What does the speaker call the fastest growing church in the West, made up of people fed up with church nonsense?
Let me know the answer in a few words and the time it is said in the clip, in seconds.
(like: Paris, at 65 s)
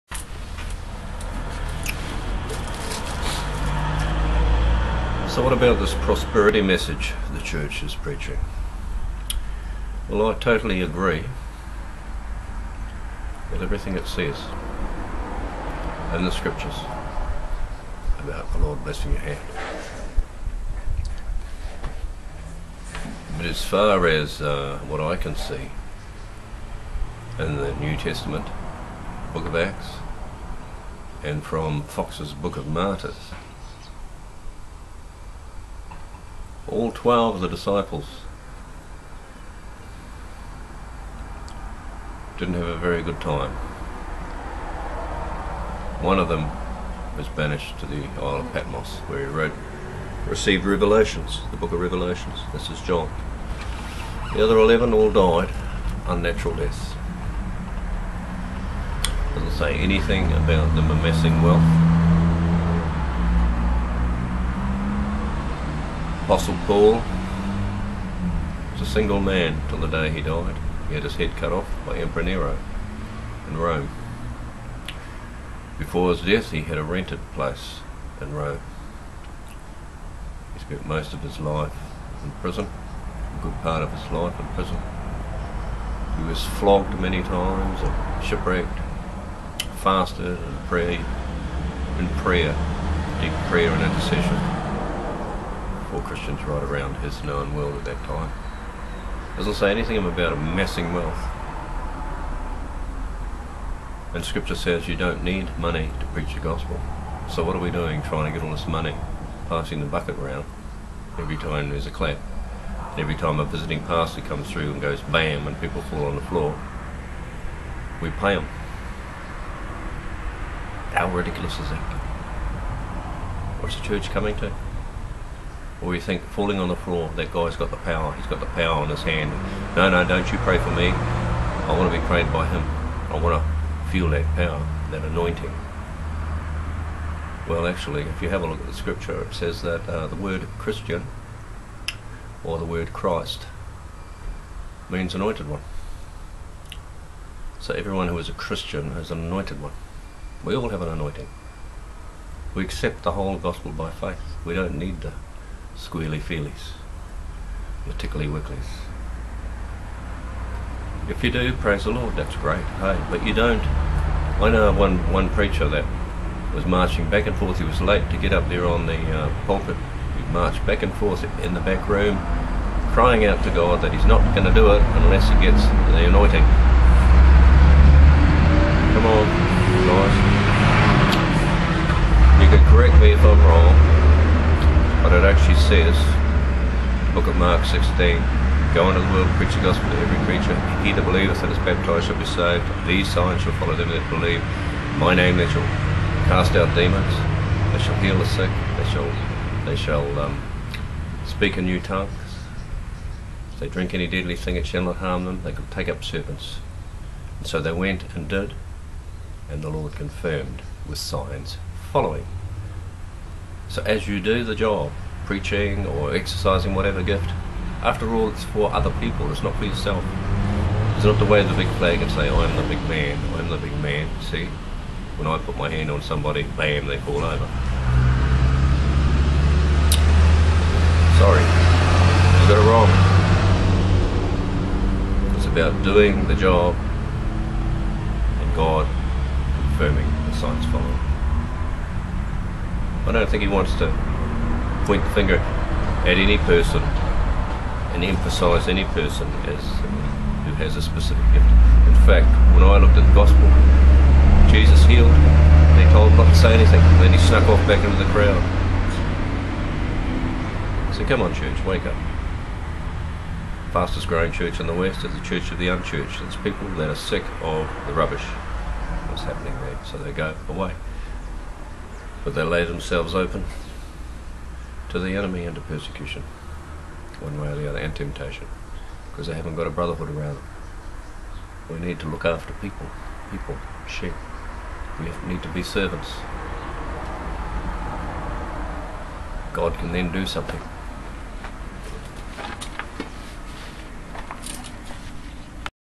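Church of the Unchurched, at 265 s.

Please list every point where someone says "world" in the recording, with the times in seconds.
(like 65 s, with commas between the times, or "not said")
97 s, 189 s.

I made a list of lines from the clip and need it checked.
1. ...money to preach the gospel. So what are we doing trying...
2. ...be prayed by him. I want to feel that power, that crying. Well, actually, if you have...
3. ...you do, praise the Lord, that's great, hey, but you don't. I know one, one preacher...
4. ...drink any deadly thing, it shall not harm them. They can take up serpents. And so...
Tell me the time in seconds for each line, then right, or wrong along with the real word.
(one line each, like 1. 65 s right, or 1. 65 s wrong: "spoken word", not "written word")
1. 105 s right
2. 131 s wrong: "anointing", not "crying"
3. 161 s right
4. 203 s right.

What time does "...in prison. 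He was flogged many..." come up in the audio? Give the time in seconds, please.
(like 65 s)
84 s.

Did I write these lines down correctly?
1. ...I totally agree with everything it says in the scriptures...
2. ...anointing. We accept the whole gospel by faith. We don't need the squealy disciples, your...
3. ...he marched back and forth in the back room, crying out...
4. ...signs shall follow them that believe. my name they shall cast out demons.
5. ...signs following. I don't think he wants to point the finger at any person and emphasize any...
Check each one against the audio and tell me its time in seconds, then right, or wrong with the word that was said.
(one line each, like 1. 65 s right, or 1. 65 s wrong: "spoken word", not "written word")
1. 10 s right
2. 150 s wrong: "feelies", not "disciples"
3. 170 s right
4. 193 s right
5. 240 s right.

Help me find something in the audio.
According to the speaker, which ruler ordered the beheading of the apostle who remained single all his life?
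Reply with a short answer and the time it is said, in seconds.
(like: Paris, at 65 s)
Emperor Nero, at 71 s.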